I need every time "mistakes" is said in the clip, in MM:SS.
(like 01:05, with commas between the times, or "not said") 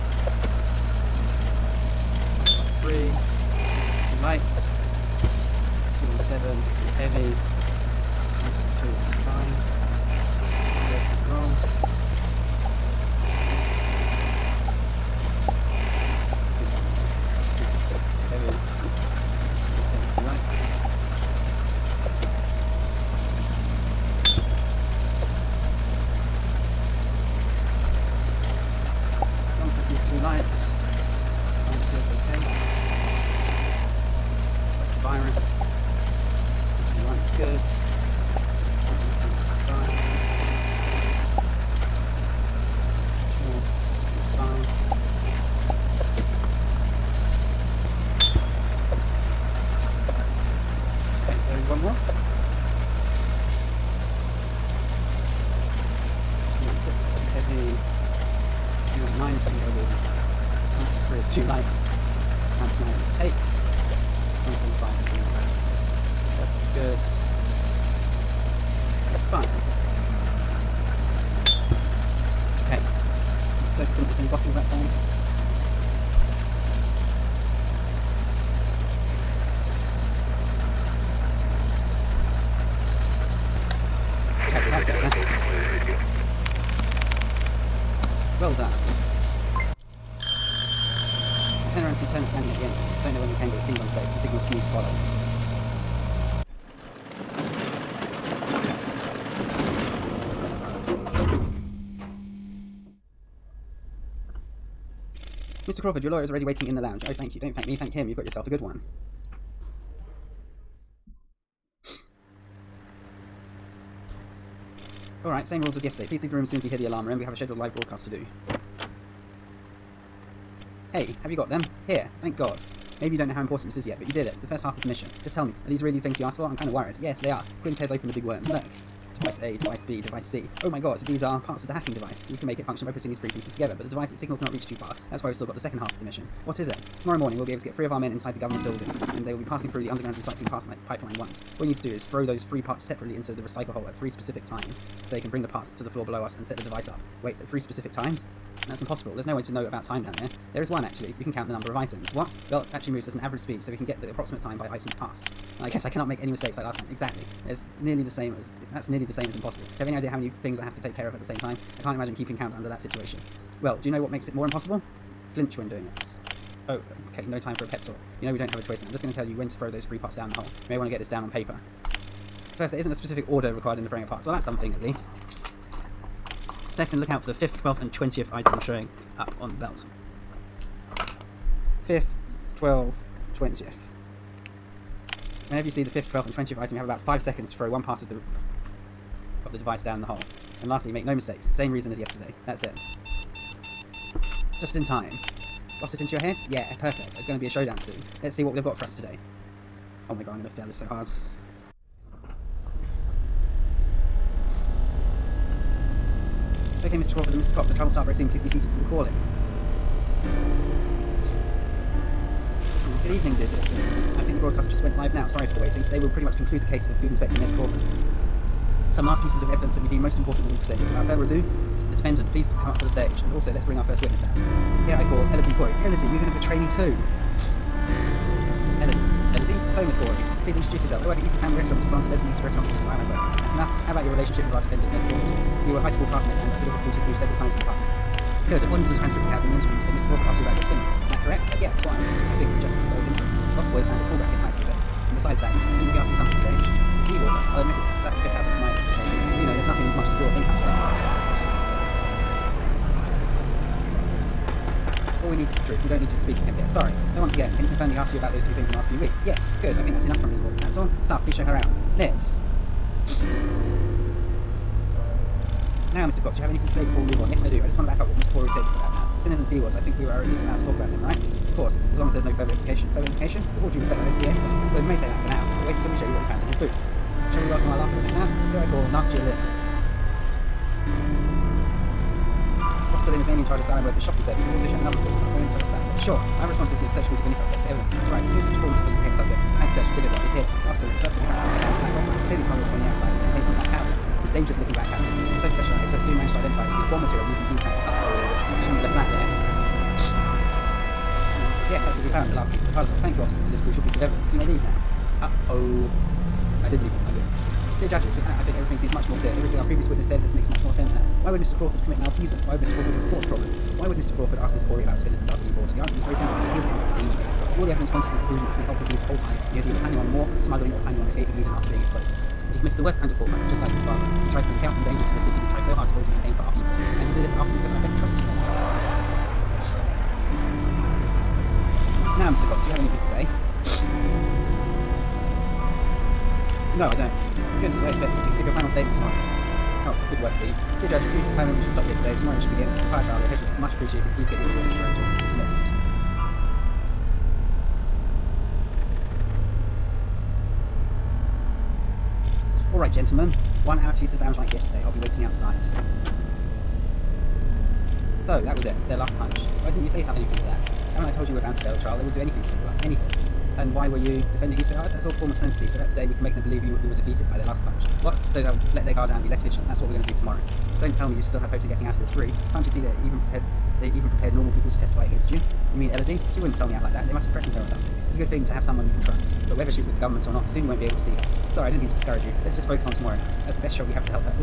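02:36, 03:11.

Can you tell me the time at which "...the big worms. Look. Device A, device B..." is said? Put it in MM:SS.
02:08.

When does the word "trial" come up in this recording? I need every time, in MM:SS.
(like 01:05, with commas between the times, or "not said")
03:27, 05:43, 06:01.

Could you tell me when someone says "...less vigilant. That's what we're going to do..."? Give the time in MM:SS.
06:09.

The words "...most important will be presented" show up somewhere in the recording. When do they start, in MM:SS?
03:40.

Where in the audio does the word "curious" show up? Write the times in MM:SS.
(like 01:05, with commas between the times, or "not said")
not said.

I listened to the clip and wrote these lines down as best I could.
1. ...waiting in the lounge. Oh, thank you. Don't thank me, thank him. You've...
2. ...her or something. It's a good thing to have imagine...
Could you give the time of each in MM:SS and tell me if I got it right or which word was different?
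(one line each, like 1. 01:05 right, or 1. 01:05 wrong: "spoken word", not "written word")
1. 01:46 right
2. 06:17 wrong: "someone", not "imagine".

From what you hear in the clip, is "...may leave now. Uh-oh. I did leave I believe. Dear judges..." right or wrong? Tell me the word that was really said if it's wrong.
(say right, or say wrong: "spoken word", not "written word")
right.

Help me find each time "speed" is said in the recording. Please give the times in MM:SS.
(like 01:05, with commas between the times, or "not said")
02:33.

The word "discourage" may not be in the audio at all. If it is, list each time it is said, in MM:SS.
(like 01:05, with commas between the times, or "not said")
06:21.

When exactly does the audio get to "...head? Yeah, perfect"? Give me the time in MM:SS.
03:16.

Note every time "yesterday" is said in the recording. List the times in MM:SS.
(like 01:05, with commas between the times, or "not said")
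01:55, 03:11, 05:54.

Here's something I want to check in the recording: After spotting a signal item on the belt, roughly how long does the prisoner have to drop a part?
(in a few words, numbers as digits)
5 seconds.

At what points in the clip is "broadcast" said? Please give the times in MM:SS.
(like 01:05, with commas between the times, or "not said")
01:57, 03:34.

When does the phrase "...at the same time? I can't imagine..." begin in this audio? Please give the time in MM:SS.
02:41.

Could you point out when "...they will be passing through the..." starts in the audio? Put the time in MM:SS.
02:19.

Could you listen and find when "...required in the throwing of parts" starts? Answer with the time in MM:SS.
02:53.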